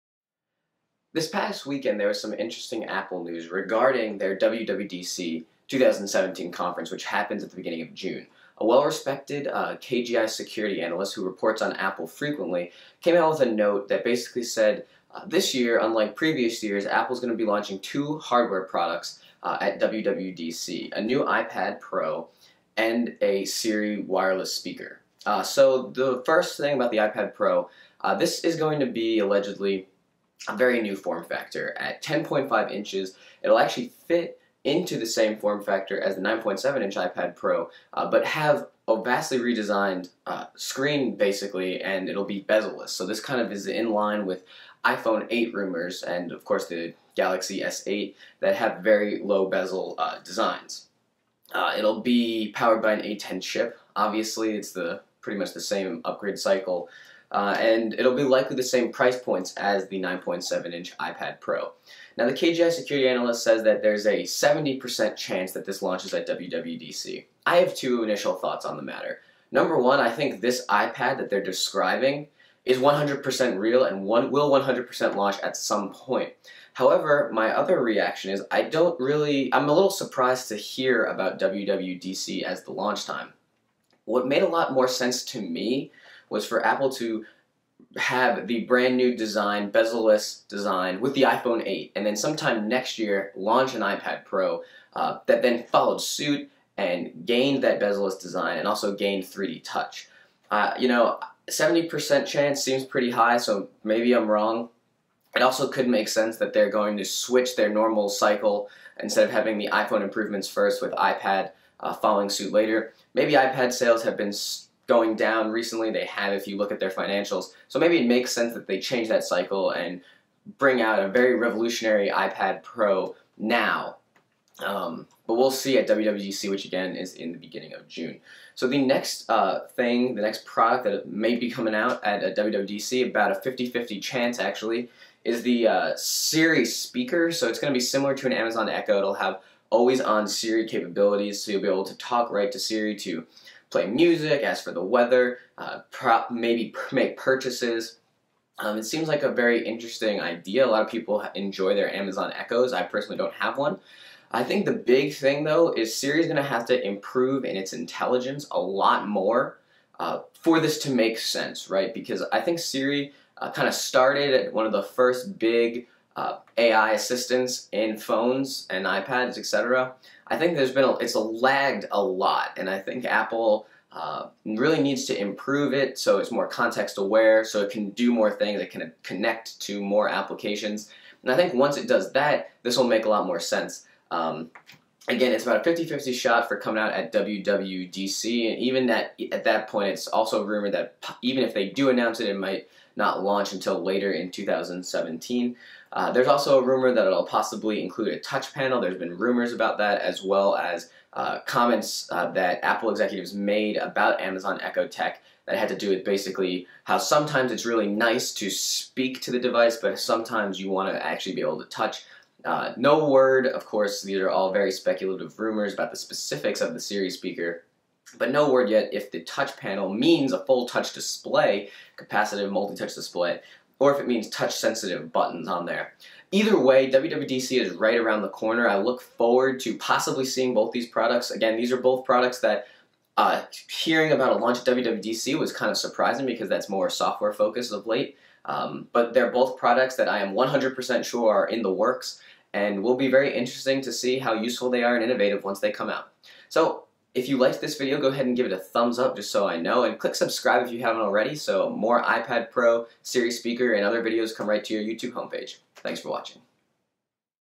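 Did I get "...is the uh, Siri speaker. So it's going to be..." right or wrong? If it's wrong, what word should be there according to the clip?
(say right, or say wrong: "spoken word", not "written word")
right.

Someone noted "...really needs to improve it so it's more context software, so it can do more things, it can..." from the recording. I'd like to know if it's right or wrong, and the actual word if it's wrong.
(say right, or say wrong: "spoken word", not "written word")
wrong: "aware", not "software".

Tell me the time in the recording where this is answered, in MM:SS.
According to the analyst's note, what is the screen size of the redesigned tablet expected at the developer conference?
00:32.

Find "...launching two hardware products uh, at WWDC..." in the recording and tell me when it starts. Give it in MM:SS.
00:17.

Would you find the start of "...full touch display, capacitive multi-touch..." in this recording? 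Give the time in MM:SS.
03:40.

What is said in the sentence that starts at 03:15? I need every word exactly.
Uh, there's also a rumor that it'll possibly include a touch panel.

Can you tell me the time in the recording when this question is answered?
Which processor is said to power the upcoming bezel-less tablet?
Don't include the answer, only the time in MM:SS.
00:53.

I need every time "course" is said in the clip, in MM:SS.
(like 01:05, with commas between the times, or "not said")
00:46, 03:33.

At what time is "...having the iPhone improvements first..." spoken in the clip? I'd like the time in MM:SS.
01:49.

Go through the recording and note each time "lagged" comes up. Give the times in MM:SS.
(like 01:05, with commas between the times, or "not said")
02:51.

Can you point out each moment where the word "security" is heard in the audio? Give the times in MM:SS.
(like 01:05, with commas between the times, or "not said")
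00:10, 01:02.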